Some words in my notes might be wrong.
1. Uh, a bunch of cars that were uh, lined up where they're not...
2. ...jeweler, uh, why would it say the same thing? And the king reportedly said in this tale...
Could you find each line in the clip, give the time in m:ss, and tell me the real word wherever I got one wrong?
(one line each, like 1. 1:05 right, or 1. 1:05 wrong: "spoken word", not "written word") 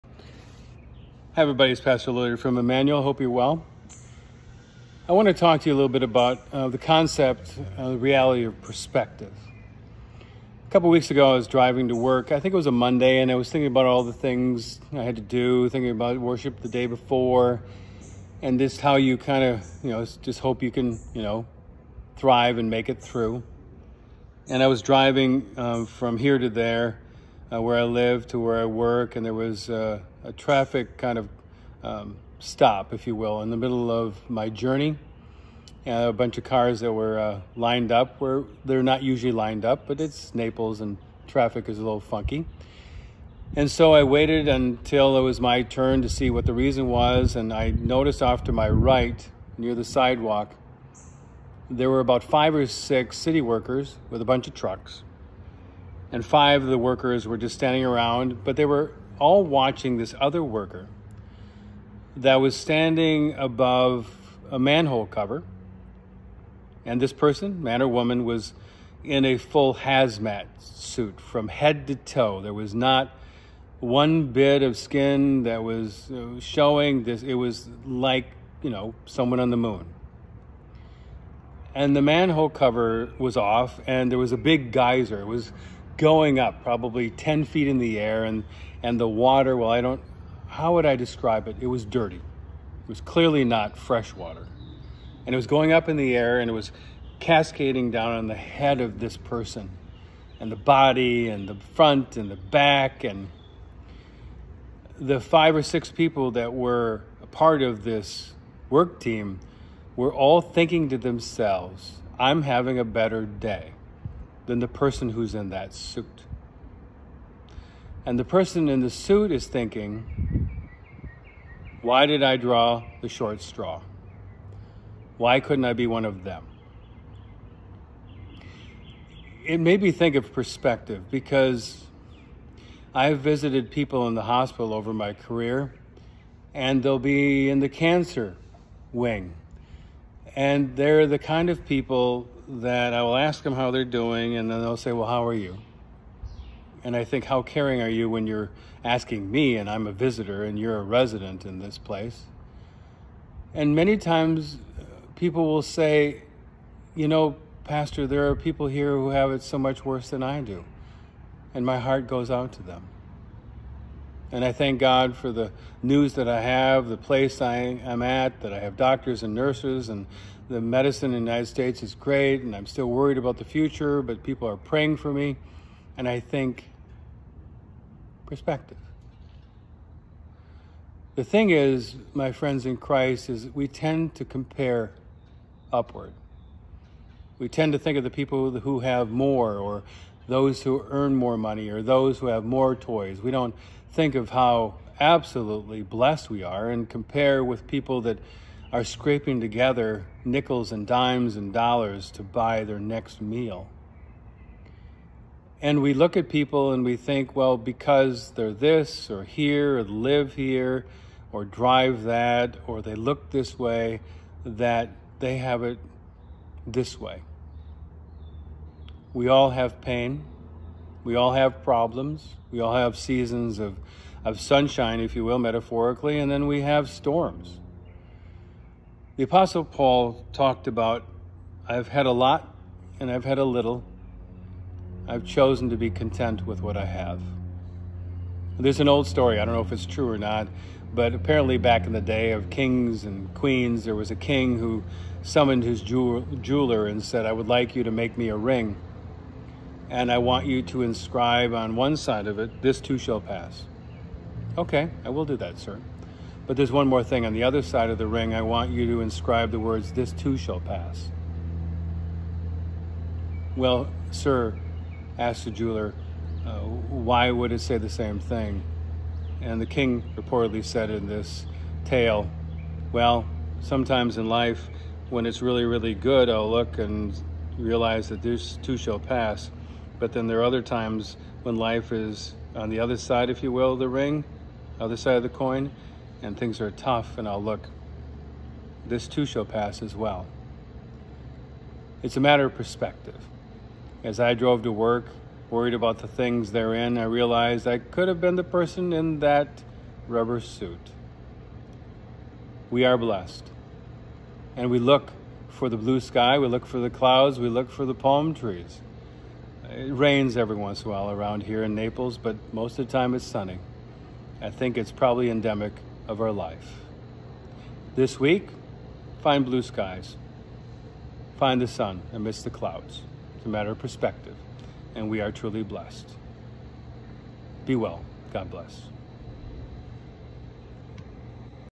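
1. 0:35 right
2. 4:25 right.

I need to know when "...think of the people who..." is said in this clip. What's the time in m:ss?
3:07.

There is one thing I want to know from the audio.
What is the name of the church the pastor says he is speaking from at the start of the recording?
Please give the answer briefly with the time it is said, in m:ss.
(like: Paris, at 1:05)
Emmanuel, at 0:02.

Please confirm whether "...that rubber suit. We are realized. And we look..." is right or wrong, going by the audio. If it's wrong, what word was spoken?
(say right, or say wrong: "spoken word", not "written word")
wrong: "blessed", not "realized".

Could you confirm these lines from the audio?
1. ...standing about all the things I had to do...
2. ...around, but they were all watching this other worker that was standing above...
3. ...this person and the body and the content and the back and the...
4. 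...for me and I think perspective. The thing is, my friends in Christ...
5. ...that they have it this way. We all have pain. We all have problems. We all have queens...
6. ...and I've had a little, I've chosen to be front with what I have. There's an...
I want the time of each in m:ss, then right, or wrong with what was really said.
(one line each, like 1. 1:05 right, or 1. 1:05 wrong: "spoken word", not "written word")
1. 0:13 wrong: "thinking", not "standing"
2. 0:57 right
3. 1:38 wrong: "front", not "content"
4. 2:54 right
5. 3:34 wrong: "seasons", not "queens"
6. 3:52 wrong: "content", not "front".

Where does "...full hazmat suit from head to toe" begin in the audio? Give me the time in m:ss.
1:09.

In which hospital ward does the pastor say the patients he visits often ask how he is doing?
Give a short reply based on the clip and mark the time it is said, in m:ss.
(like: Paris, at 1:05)
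cancer wing, at 2:17.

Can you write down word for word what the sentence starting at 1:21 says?
And the manhole cover was off, and there was a big geyser.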